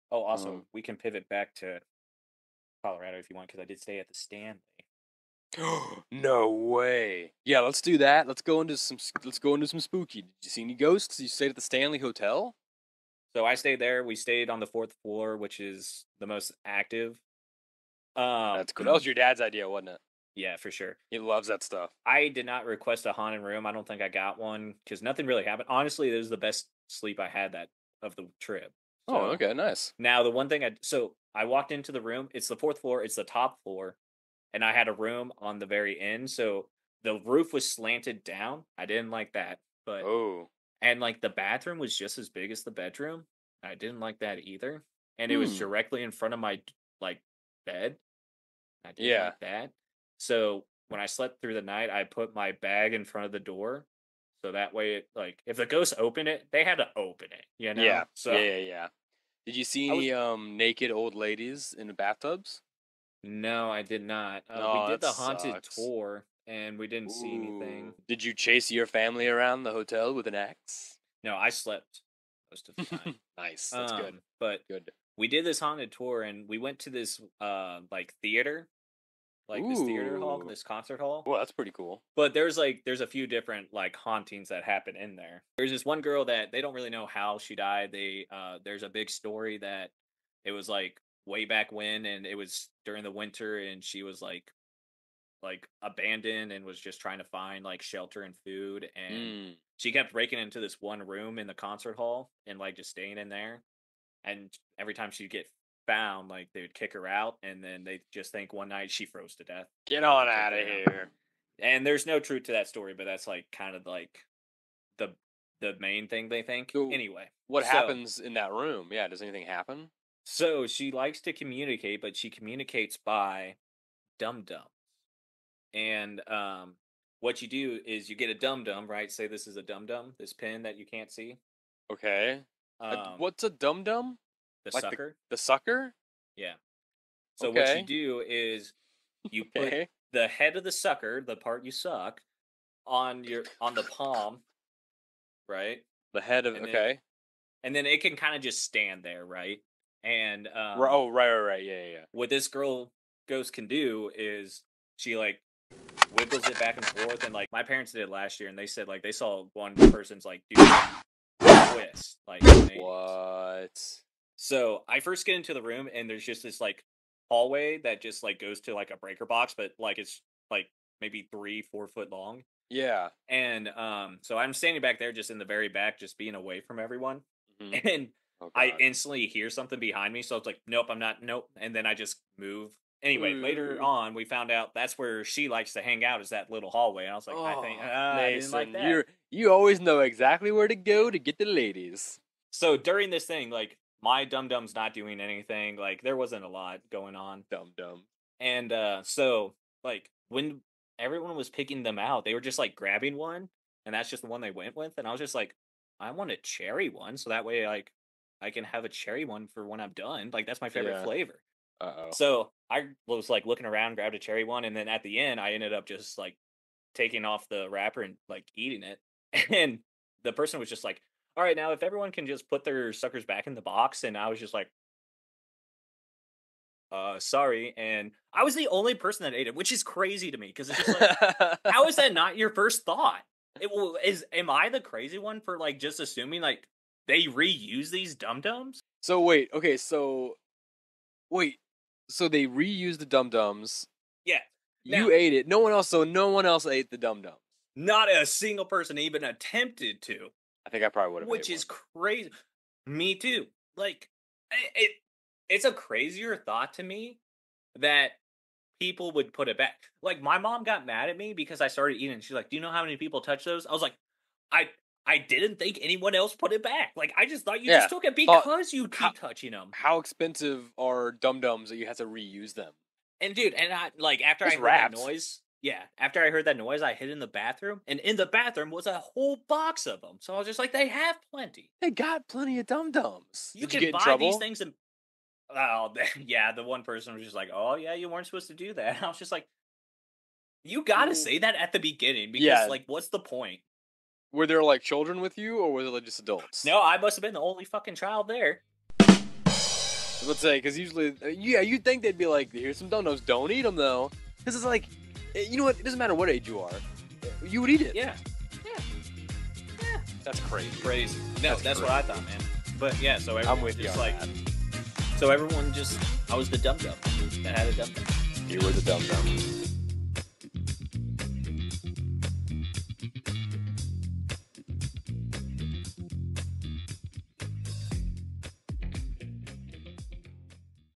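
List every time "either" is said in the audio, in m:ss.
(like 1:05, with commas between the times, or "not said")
0:44.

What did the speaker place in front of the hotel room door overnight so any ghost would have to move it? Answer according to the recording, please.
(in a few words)
bag.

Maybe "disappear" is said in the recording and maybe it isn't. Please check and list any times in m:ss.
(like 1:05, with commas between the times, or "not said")
not said.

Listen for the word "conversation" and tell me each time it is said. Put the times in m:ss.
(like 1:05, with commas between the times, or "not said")
not said.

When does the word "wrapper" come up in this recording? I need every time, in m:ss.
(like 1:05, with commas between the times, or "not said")
3:37.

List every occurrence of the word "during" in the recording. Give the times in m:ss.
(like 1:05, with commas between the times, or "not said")
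1:32, 3:12.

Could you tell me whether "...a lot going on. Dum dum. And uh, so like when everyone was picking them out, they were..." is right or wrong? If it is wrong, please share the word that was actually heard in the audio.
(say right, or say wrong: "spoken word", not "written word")
right.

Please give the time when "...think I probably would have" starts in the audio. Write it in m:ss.
4:10.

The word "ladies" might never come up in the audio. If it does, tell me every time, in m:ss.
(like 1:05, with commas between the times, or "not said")
1:01, 3:11.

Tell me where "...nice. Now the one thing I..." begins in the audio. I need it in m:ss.
0:29.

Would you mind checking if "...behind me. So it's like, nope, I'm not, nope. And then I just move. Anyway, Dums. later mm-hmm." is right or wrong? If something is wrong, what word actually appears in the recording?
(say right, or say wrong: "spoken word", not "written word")
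wrong: "Ooh", not "Dums".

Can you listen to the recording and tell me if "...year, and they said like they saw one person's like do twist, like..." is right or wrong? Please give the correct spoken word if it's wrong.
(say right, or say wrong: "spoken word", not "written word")
right.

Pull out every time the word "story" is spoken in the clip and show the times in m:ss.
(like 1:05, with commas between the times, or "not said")
1:29, 1:52.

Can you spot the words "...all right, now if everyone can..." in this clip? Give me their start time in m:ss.
3:41.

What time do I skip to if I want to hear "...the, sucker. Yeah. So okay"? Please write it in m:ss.
2:15.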